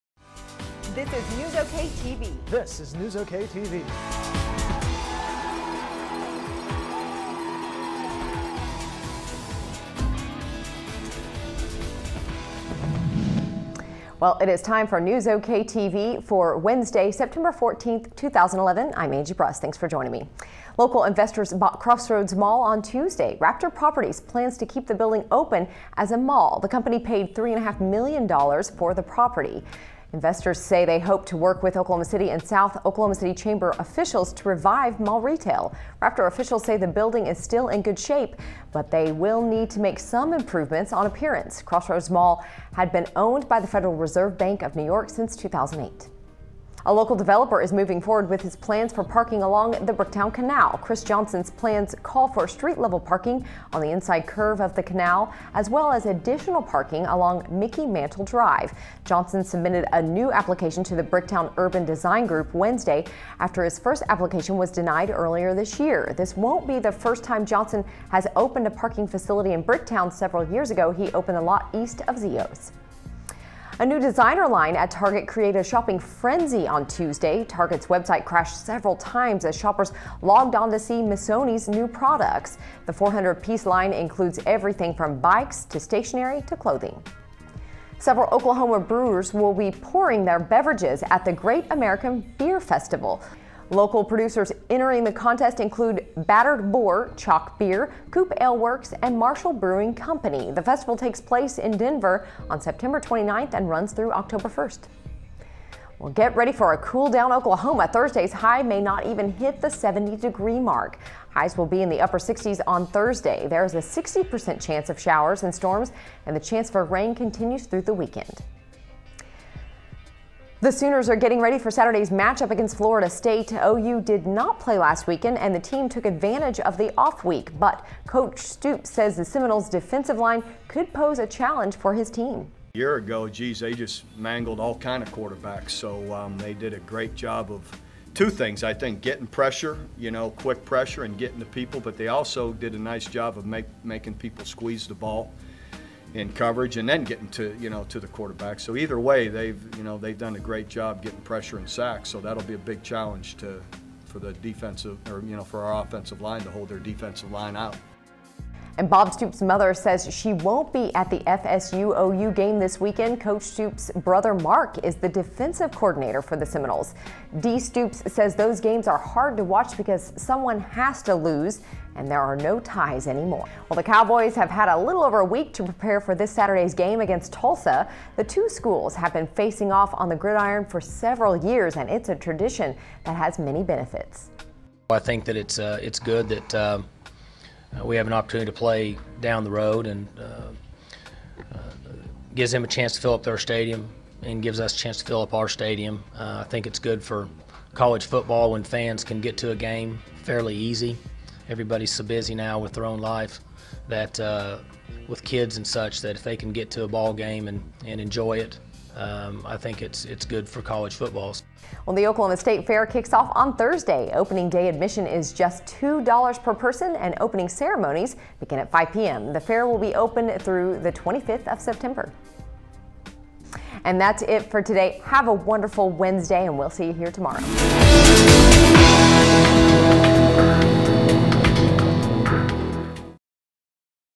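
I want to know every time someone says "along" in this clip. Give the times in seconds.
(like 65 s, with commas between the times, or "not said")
49 s, 57 s.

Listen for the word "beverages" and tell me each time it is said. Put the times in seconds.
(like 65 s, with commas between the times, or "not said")
90 s.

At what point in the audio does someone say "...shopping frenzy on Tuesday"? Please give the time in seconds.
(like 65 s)
75 s.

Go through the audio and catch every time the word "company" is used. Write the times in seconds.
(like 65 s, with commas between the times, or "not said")
26 s, 99 s.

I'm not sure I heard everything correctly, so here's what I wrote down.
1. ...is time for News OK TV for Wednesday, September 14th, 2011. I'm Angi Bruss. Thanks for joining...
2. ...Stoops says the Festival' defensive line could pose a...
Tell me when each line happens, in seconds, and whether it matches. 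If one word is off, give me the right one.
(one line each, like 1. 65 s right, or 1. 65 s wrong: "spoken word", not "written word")
1. 14 s right
2. 128 s wrong: "Seminoles", not "Festival".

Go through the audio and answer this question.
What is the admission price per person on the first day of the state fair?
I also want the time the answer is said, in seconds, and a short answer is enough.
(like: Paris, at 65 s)
$2, at 215 s.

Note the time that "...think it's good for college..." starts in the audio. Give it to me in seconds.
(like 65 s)
196 s.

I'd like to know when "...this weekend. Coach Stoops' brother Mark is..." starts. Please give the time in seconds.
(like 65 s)
162 s.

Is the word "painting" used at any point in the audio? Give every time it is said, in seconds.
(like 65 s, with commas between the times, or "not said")
not said.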